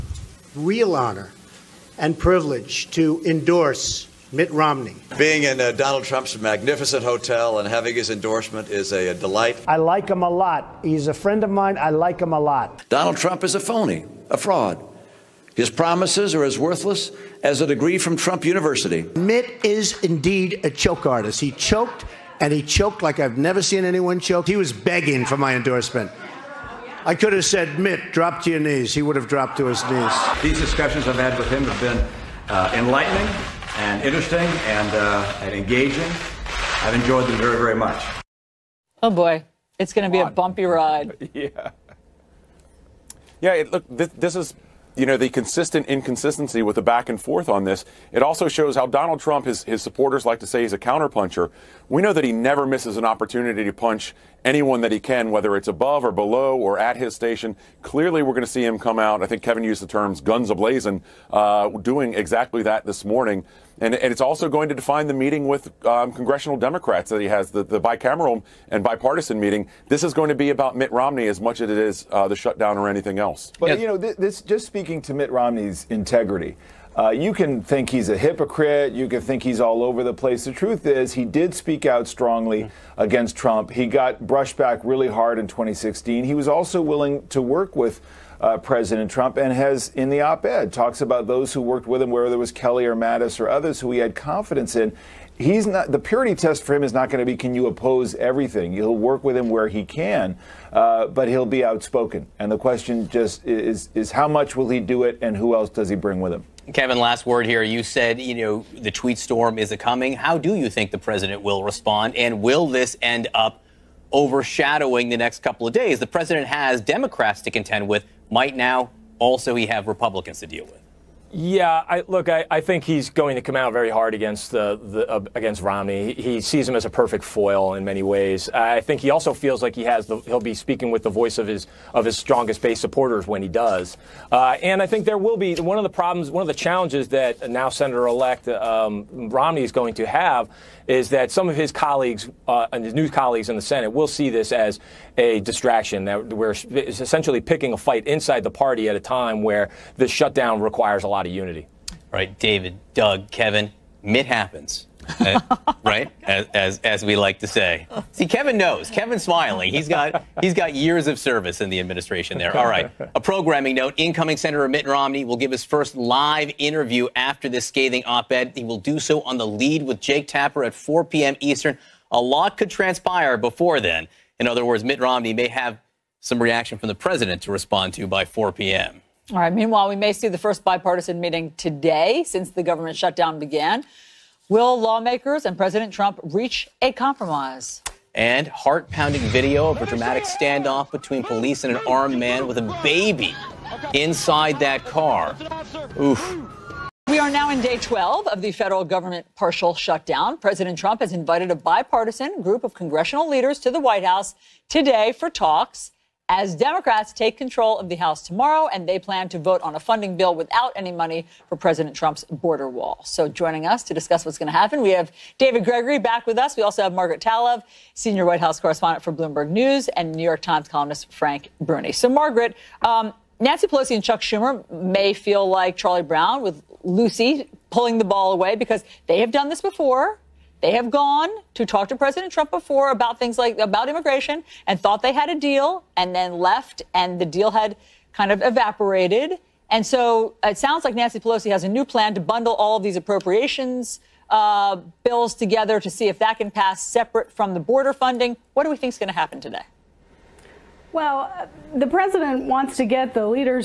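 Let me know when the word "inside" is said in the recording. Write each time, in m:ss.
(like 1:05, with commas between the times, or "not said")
2:28, 3:13.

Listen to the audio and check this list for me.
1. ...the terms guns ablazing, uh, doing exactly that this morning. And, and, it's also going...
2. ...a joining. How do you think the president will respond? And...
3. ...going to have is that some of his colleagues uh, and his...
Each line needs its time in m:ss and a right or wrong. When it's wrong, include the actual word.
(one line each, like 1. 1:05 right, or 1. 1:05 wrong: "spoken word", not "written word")
1. 0:59 right
2. 1:49 wrong: "coming", not "joining"
3. 2:19 right.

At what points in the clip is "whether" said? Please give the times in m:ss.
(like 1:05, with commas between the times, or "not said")
0:55, 1:32.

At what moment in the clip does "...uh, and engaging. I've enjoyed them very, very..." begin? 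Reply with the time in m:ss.
0:34.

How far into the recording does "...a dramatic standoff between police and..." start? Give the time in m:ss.
3:09.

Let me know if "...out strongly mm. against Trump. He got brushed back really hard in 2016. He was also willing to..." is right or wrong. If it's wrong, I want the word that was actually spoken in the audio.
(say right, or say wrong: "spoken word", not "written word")
right.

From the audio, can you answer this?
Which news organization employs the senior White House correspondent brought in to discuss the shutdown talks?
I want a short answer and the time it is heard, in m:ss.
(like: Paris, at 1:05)
Bloomberg News, at 3:39.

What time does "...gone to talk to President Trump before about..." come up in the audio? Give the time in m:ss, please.
3:50.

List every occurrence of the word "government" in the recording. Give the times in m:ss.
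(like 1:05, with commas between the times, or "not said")
3:02, 3:18.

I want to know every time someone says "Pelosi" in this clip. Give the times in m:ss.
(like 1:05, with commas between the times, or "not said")
3:43, 4:01.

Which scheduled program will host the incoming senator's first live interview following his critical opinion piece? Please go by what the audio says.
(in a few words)
The Lead with Jake Tapper.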